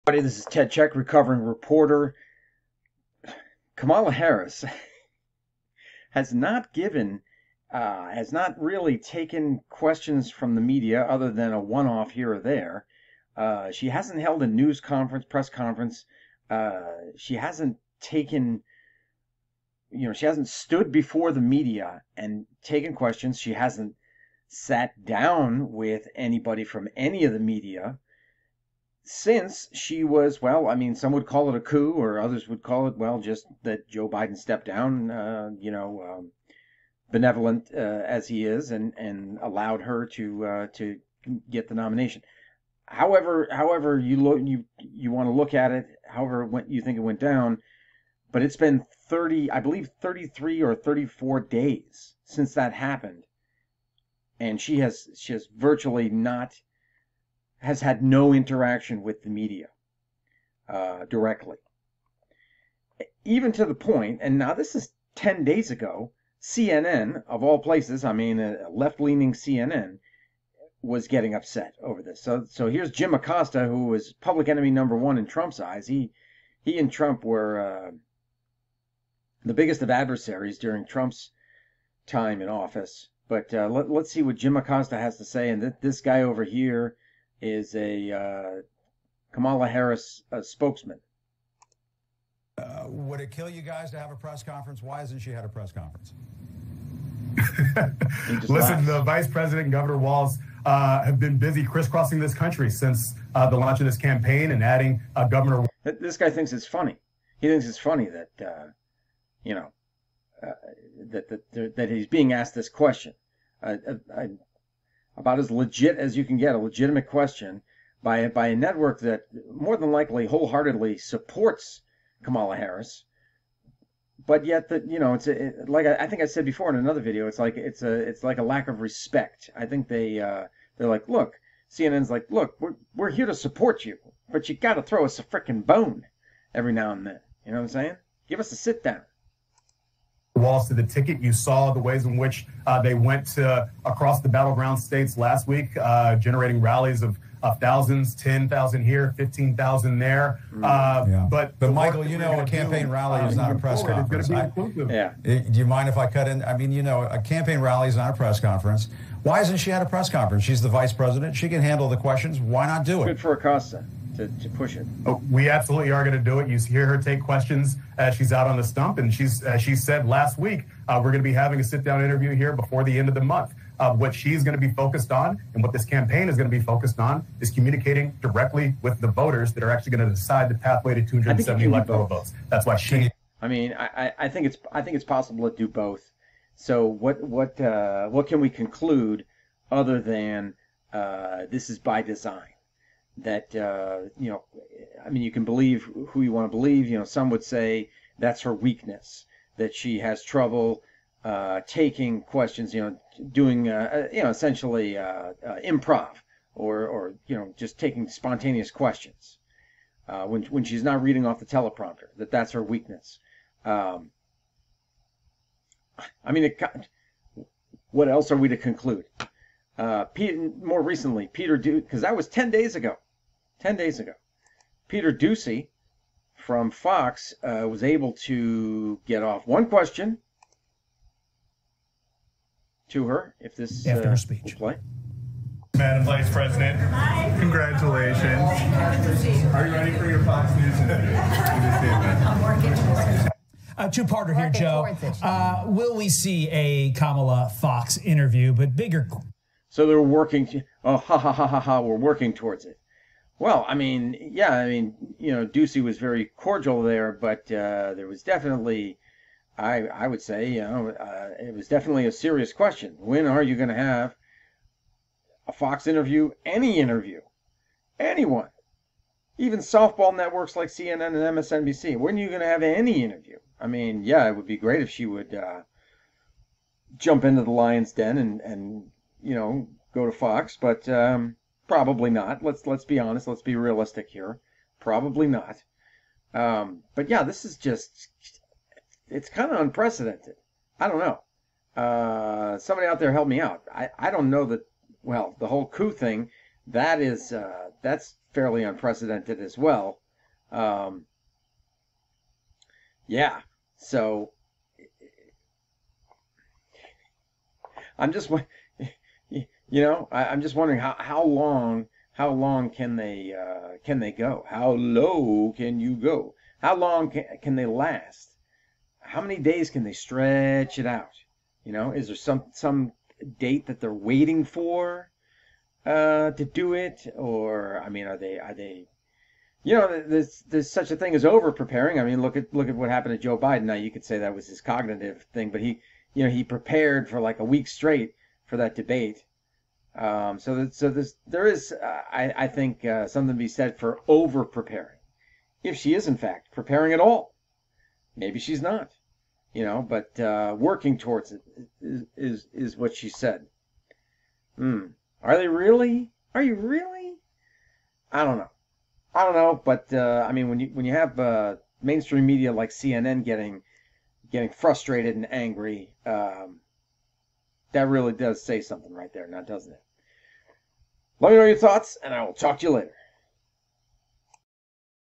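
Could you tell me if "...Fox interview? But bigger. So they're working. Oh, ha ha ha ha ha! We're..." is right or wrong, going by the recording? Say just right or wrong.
right.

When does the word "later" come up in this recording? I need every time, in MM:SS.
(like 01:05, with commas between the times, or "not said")
06:12.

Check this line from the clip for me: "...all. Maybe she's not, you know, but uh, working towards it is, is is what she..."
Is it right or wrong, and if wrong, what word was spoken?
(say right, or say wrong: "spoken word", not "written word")
right.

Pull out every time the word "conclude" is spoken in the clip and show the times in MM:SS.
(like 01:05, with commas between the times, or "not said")
03:08, 03:38.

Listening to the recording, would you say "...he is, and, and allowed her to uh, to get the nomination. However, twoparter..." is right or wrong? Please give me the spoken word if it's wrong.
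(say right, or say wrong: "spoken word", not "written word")
wrong: "however", not "twoparter".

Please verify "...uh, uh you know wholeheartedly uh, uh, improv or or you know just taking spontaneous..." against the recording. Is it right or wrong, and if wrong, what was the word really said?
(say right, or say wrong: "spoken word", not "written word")
wrong: "essentially", not "wholeheartedly".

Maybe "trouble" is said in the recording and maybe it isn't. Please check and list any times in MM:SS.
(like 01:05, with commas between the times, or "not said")
03:20.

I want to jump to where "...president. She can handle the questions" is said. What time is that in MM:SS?
02:40.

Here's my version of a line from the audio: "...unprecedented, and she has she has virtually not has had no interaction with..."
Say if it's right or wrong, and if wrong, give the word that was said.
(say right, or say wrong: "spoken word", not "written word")
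wrong: "happened", not "unprecedented".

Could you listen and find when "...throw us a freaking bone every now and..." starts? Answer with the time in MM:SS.
02:14.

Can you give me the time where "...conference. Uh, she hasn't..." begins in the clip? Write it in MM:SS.
00:15.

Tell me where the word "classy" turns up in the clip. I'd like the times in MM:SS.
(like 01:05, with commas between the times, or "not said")
not said.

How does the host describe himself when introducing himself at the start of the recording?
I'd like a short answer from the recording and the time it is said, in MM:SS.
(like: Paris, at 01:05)
Recovering reporter, at 00:00.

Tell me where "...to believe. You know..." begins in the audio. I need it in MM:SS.
03:16.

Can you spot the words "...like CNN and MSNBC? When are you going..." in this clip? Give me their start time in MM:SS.
04:30.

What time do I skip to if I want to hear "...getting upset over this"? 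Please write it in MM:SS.
01:11.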